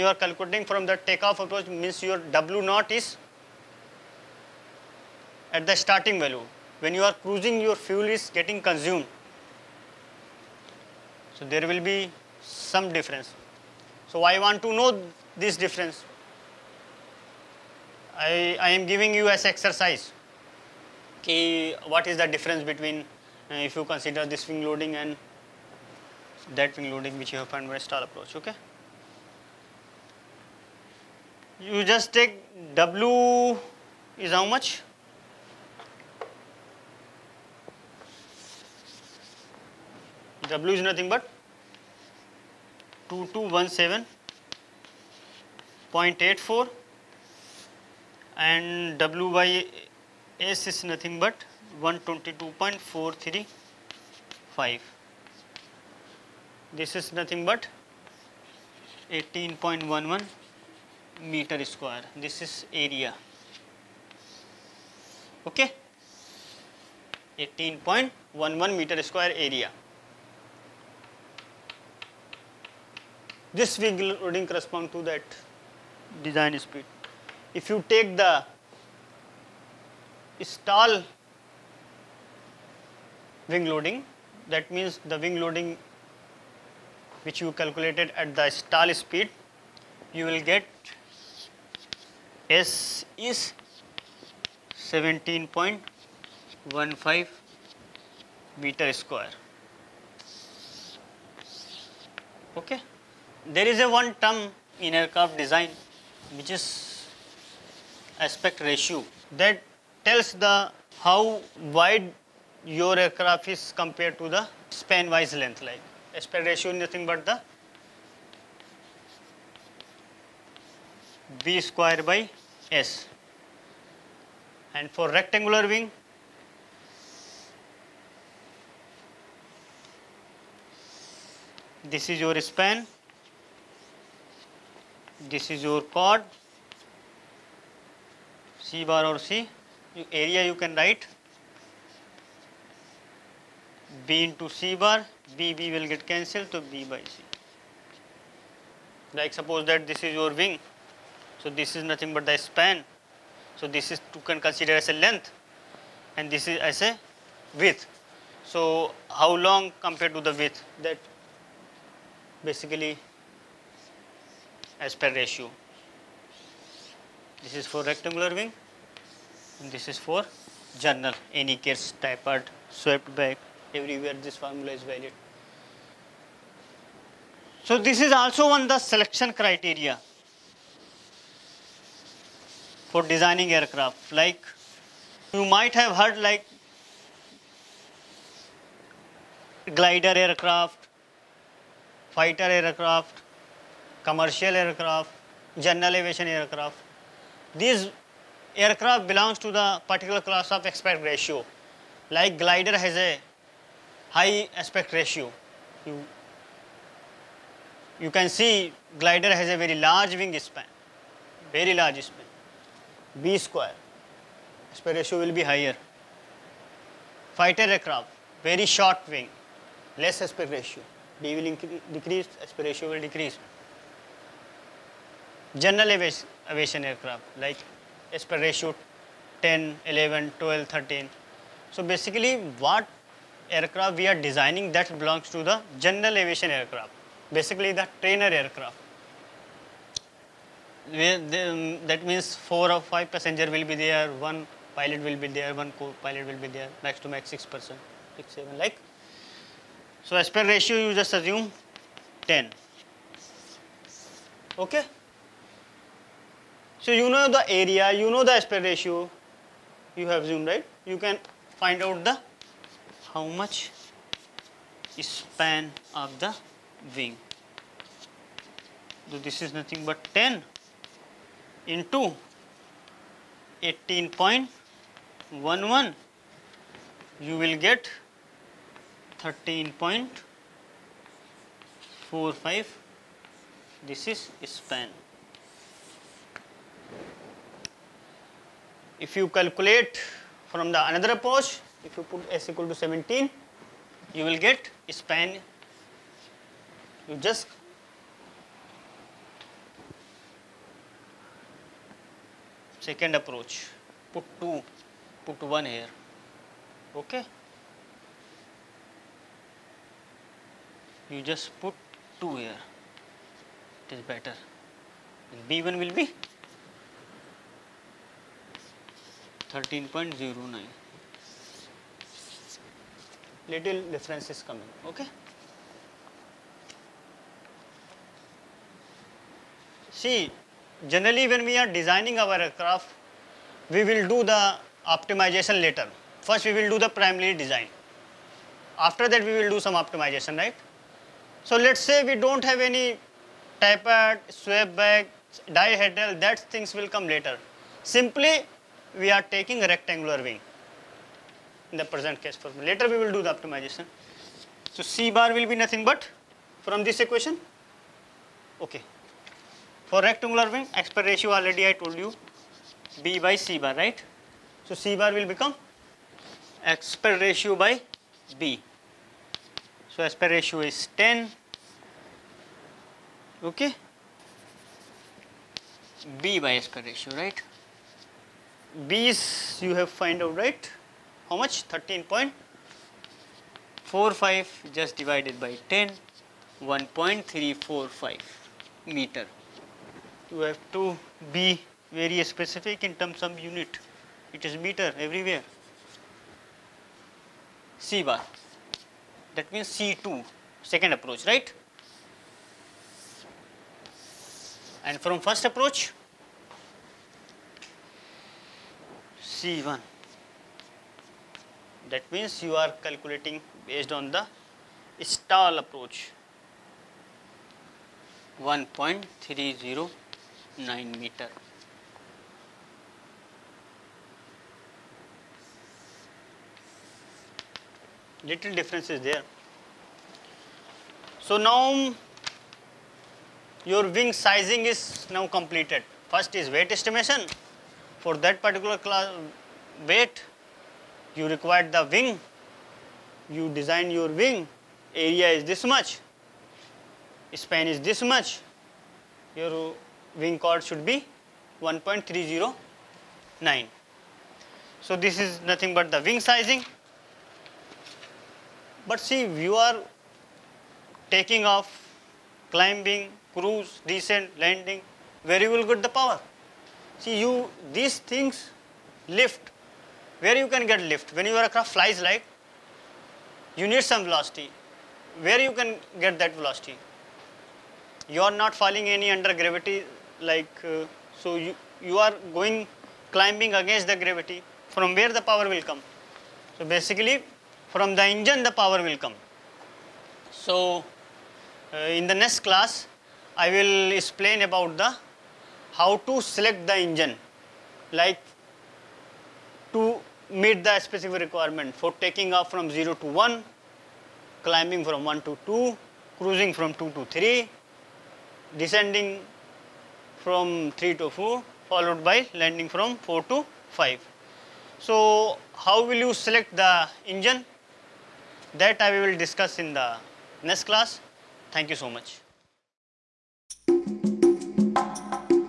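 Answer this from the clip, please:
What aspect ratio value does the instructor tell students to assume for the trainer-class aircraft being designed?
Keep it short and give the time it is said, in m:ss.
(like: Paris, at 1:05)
10, at 4:10.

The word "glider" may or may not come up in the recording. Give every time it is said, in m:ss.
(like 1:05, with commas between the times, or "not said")
3:09, 3:22, 3:28.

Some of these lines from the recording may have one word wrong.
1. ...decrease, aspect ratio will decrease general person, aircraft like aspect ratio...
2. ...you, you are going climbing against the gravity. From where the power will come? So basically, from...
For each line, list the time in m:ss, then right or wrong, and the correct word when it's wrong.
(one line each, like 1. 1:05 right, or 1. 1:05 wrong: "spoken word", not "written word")
1. 3:41 wrong: "aviation", not "person"
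2. 8:01 right.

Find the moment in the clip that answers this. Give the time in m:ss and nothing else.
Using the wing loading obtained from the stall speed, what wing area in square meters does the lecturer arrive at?
1:34.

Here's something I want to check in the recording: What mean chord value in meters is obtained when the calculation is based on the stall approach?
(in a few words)
1.309.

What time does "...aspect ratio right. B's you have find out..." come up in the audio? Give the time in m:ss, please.
6:16.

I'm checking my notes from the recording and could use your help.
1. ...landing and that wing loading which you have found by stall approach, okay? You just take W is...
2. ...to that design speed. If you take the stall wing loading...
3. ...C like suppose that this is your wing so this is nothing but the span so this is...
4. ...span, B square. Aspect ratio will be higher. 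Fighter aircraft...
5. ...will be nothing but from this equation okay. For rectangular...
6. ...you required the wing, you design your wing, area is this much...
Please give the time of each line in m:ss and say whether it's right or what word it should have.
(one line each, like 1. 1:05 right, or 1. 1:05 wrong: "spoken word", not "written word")
1. 0:24 wrong: "loading", not "landing"
2. 1:14 right
3. 2:26 right
4. 3:32 right
5. 5:55 right
6. 7:21 right.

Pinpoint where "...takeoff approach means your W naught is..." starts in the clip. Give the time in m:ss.
0:00.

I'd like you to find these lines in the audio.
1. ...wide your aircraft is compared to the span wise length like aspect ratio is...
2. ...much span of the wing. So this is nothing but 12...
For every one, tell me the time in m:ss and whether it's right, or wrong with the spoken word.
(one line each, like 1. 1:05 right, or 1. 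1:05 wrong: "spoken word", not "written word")
1. 1:51 right
2. 4:23 wrong: "10", not "12".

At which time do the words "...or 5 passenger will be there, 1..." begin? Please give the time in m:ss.
4:02.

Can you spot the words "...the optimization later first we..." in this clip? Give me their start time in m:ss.
5:34.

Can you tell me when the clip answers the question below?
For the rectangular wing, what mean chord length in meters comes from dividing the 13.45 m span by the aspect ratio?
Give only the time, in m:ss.
6:26.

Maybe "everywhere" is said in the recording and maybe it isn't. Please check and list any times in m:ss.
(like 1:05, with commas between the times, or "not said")
2:53, 6:34.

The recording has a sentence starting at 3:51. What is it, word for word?
So basically what aircraft we are designing that belongs to the general aviation aircraft, basically the trainer aircraft.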